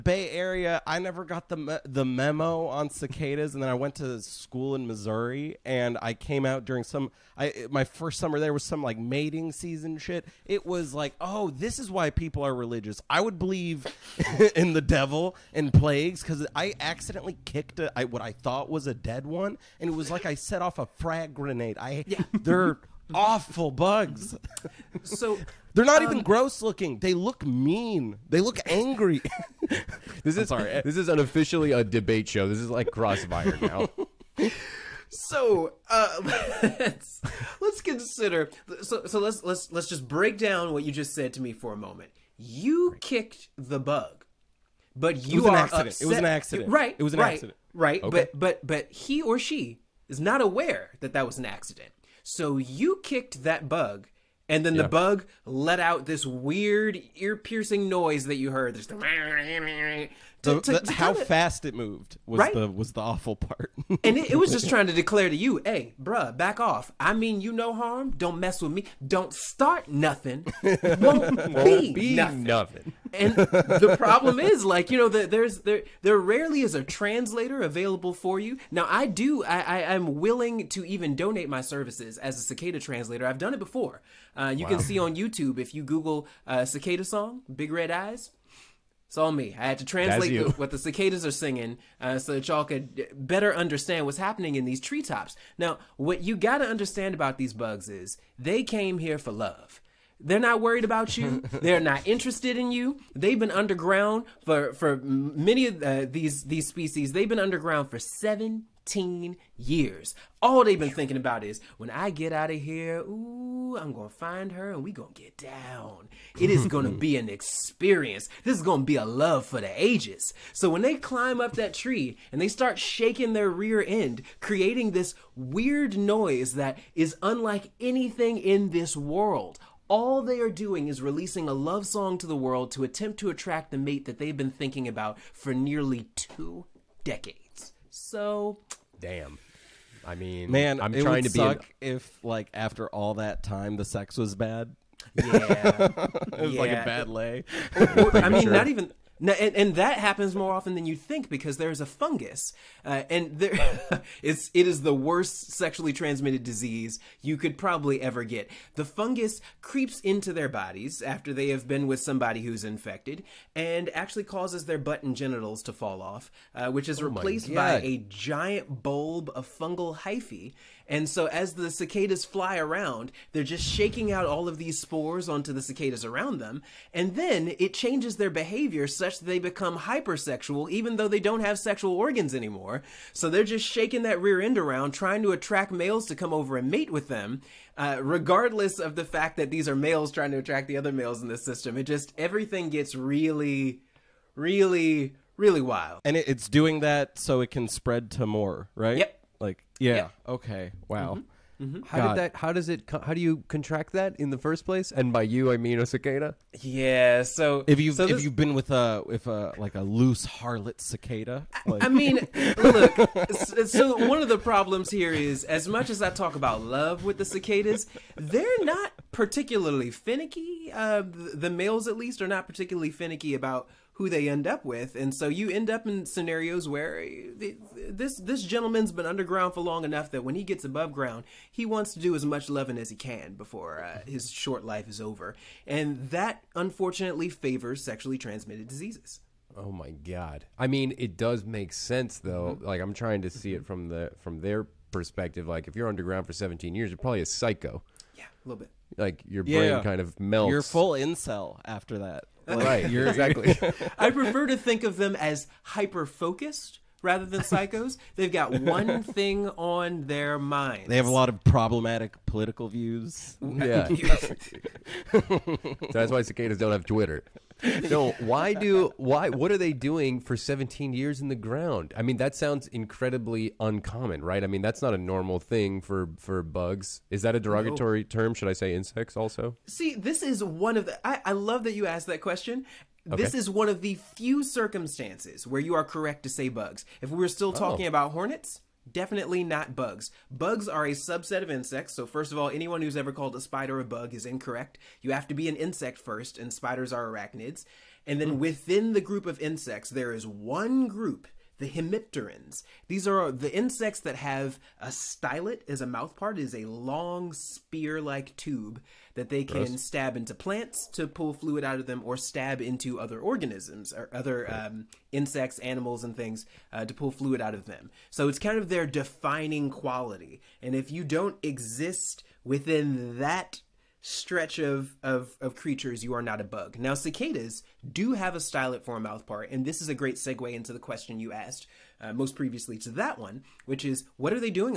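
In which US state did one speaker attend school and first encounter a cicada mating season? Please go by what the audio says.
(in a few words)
Missouri.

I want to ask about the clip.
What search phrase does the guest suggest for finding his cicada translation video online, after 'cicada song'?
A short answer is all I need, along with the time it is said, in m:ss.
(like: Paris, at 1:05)
big red eyes, at 1:27.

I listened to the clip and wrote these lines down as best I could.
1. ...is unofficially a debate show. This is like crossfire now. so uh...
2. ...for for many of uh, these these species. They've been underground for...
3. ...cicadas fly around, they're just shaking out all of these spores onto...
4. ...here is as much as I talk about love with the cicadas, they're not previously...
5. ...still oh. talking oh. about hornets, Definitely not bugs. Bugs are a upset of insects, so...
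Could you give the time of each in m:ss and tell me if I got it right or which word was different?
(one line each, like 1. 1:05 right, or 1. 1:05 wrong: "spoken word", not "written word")
1. 0:30 right
2. 1:44 right
3. 2:51 right
4. 3:34 wrong: "particularly", not "previously"
5. 4:47 wrong: "subset", not "upset".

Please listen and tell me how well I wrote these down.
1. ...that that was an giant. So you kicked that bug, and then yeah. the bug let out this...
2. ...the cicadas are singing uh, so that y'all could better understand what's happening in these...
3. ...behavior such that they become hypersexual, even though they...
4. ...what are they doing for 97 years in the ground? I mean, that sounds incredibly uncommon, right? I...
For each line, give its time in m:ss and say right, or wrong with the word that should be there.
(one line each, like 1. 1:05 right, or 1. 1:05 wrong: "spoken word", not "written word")
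1. 0:51 wrong: "accident", not "giant"
2. 1:30 right
3. 2:58 right
4. 4:29 wrong: "17", not "97".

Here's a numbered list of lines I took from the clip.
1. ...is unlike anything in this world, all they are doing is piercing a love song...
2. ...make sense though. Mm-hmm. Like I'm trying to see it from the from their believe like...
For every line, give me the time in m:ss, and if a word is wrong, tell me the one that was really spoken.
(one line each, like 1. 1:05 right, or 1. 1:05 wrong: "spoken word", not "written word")
1. 2:06 wrong: "releasing", not "piercing"
2. 4:01 wrong: "perspective", not "believe".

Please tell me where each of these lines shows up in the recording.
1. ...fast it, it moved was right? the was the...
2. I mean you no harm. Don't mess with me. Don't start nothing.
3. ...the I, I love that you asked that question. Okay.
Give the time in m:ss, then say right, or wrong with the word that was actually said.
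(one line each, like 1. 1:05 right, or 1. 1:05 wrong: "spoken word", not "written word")
1. 1:01 right
2. 1:07 right
3. 4:40 right.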